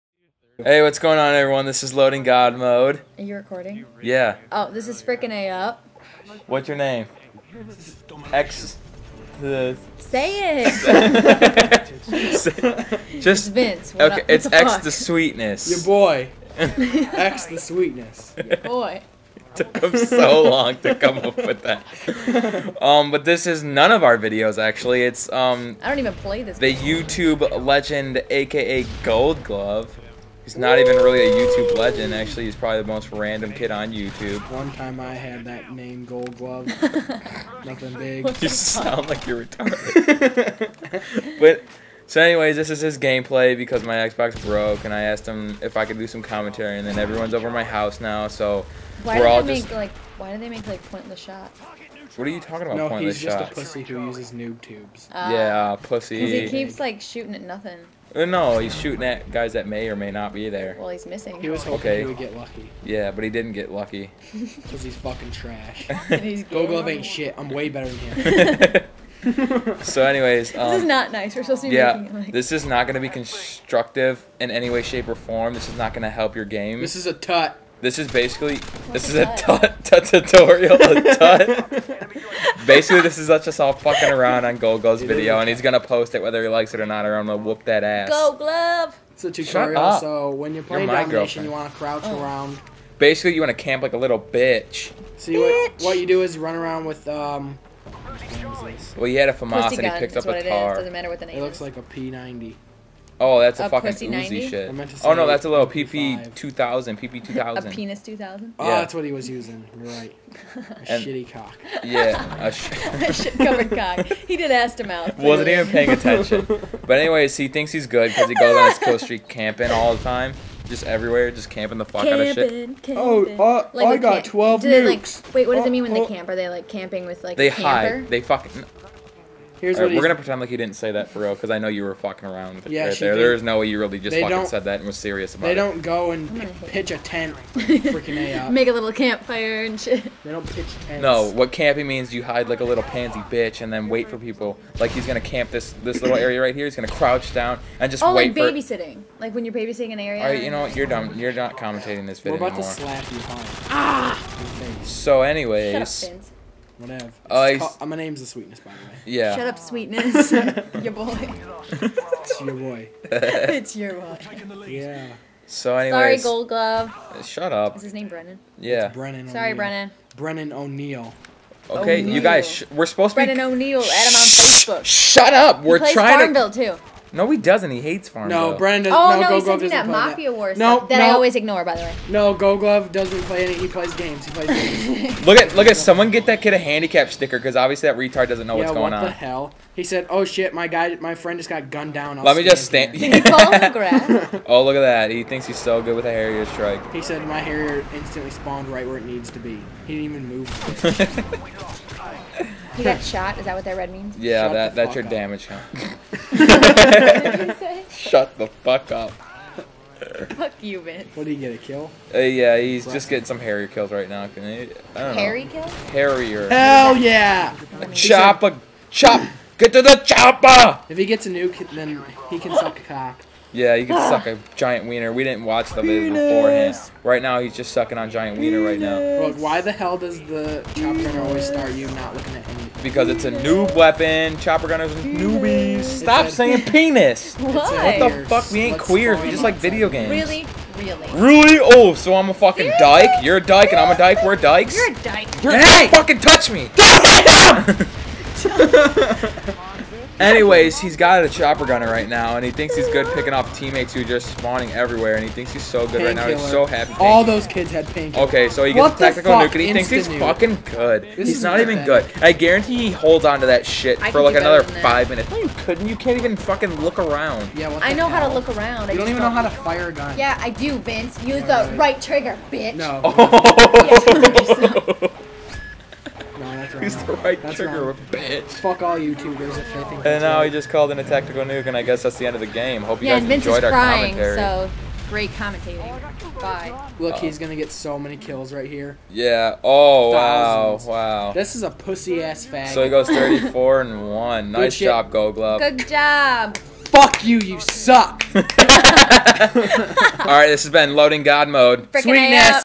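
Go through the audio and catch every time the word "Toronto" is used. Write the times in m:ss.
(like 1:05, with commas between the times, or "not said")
not said.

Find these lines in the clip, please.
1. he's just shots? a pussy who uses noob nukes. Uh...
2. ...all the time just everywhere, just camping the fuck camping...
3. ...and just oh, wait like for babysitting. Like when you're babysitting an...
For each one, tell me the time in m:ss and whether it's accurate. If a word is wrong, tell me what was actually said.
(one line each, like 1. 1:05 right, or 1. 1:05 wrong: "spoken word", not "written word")
1. 0:53 wrong: "tubes", not "nukes"
2. 1:59 right
3. 2:27 right.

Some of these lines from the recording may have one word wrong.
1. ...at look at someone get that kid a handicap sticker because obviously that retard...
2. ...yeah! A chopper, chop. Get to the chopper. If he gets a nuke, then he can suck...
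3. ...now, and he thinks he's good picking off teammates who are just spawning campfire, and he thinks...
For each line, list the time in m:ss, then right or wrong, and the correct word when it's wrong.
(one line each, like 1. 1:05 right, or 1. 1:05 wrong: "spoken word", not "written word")
1. 3:05 right
2. 3:36 right
3. 4:12 wrong: "everywhere", not "campfire".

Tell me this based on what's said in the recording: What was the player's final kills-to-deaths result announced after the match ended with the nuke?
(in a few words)
34 and 1.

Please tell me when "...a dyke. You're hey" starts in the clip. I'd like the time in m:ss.
4:04.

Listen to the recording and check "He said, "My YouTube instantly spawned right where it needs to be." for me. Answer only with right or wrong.
wrong.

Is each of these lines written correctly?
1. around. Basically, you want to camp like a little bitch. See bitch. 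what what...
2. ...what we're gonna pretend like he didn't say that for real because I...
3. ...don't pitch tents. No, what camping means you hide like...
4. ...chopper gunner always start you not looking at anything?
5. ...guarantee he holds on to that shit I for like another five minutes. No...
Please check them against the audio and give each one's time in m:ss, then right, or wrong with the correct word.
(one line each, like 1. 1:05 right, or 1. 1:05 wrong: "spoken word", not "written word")
1. 1:32 right
2. 2:09 right
3. 2:20 right
4. 3:50 right
5. 4:22 right.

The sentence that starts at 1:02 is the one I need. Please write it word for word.
Yeah, but he didn't get lucky.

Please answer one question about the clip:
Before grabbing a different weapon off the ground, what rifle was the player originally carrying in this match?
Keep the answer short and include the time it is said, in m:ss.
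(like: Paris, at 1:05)
FAMAS, at 1:39.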